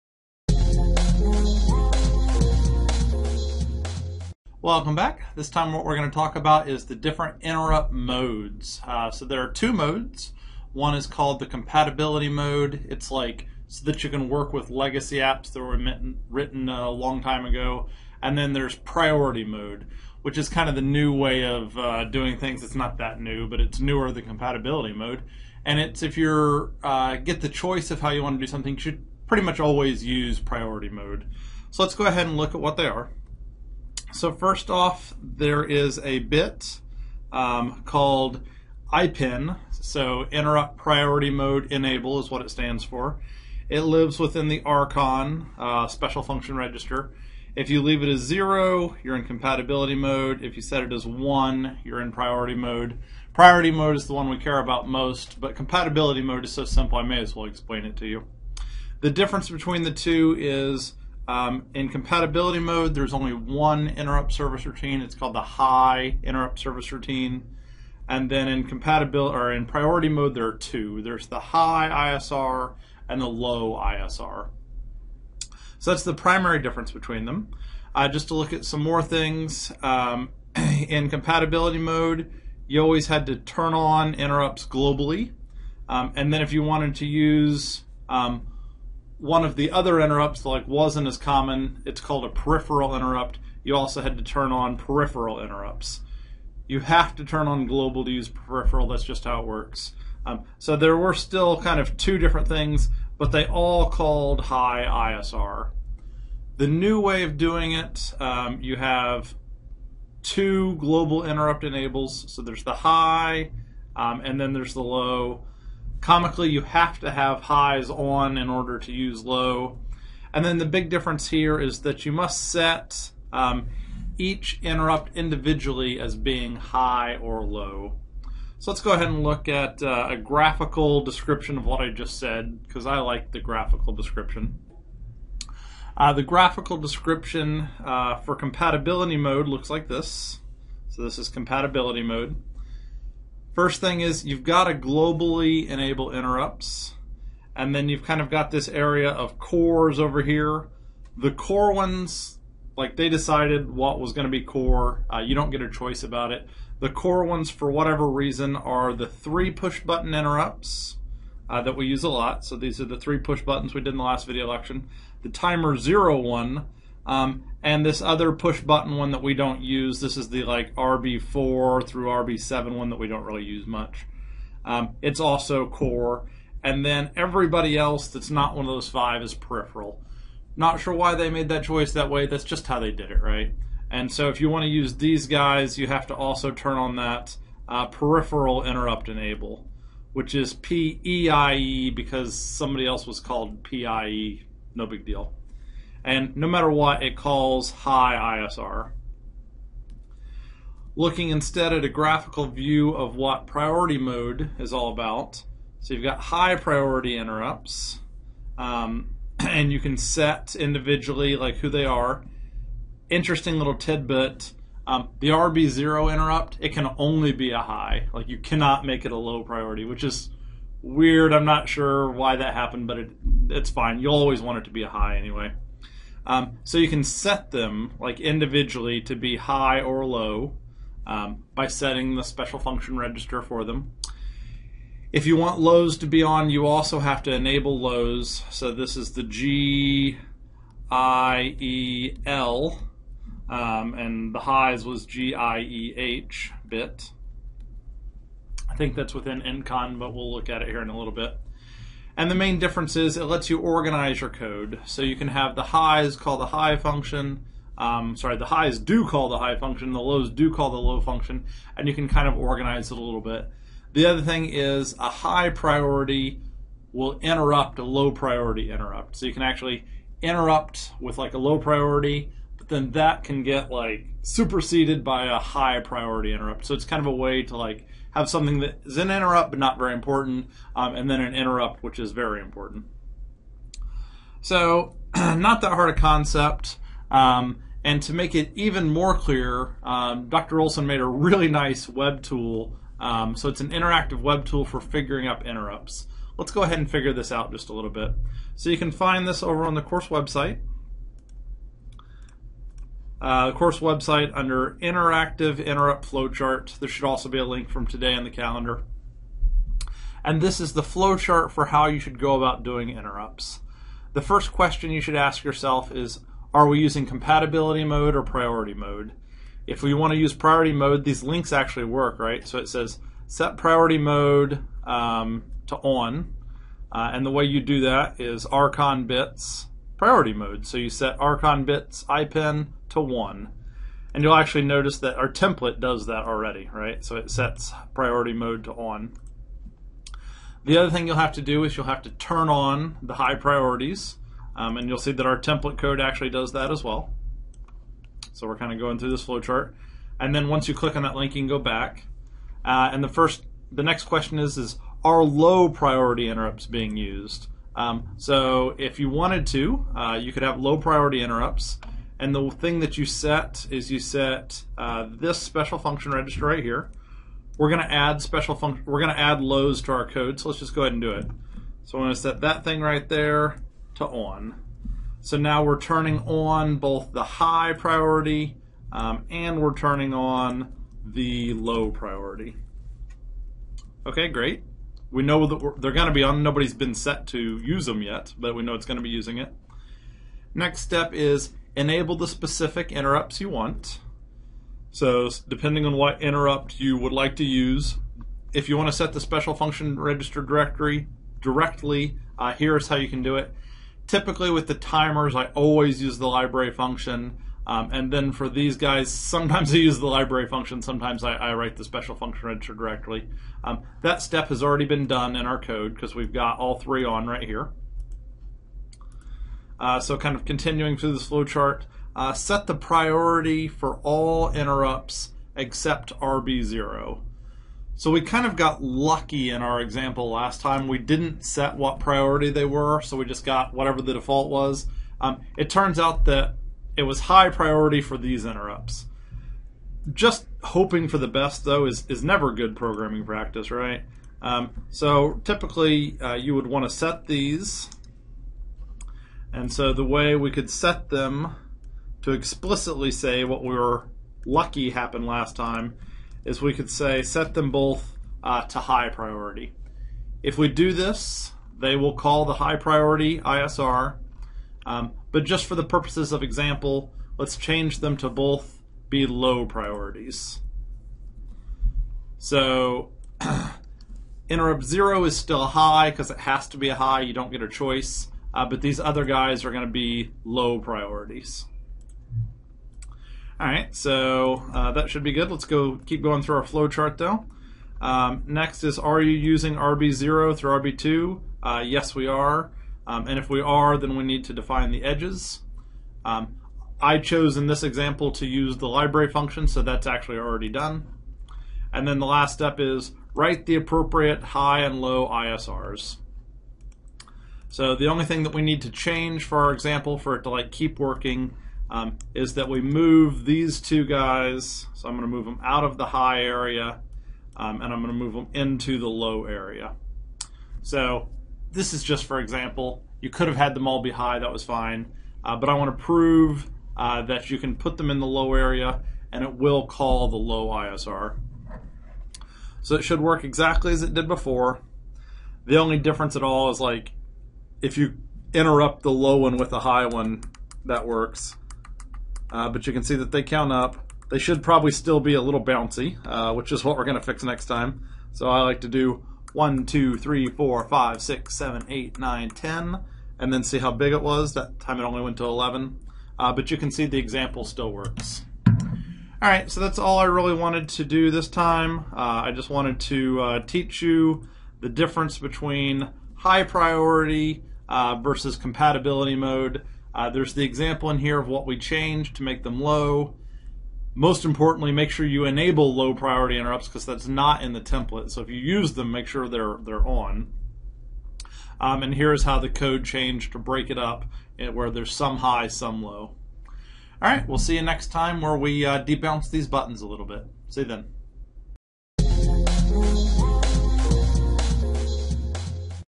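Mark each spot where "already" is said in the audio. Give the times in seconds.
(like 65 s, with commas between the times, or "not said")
336 s, 414 s, 500 s.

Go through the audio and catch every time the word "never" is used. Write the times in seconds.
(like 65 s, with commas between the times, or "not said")
442 s.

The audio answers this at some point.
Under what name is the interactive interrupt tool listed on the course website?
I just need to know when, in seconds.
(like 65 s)
304 s.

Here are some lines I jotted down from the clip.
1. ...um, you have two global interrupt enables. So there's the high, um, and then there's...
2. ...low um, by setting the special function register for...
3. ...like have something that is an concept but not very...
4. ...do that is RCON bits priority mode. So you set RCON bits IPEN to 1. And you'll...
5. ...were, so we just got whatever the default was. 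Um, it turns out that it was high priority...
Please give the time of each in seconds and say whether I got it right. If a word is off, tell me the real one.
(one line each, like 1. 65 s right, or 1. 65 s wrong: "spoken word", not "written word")
1. 108 s right
2. 230 s right
3. 277 s wrong: "interrupt", not "concept"
4. 327 s right
5. 432 s right.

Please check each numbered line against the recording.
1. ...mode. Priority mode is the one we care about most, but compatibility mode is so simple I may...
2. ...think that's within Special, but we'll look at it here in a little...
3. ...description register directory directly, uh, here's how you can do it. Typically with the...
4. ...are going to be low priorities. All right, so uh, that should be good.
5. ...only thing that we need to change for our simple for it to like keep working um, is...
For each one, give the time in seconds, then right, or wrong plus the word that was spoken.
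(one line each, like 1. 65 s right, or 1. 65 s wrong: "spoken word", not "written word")
1. 52 s right
2. 248 s wrong: "INTCON", not "Special"
3. 399 s wrong: "function", not "description"
4. 479 s right
5. 508 s wrong: "example", not "simple".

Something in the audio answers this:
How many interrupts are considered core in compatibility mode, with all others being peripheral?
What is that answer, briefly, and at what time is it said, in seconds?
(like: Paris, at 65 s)
five, at 178 s.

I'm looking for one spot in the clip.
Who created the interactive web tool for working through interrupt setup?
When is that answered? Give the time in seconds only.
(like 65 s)
290 s.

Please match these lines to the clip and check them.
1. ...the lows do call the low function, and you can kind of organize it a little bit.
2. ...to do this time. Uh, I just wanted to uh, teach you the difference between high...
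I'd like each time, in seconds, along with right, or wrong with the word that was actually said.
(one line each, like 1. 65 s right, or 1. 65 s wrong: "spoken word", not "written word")
1. 259 s right
2. 560 s right.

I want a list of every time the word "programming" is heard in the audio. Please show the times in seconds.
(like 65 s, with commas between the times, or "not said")
442 s.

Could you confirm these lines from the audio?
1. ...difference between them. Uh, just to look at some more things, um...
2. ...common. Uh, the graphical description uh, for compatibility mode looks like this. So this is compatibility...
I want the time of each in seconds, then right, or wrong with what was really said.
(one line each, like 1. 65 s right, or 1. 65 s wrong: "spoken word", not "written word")
1. 76 s right
2. 133 s wrong: "description", not "common".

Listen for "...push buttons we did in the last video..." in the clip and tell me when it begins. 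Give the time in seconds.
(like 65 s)
163 s.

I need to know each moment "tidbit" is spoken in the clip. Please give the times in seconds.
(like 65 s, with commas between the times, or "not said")
213 s.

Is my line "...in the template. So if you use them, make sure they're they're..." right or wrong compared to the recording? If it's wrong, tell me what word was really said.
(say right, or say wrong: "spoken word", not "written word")
right.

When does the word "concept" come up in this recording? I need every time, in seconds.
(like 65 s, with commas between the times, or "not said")
285 s.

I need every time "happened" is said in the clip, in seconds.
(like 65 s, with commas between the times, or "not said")
222 s, 454 s.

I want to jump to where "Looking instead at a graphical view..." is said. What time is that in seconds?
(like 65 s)
200 s.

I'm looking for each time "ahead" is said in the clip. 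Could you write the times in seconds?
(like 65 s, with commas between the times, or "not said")
32 s, 128 s, 296 s, 370 s.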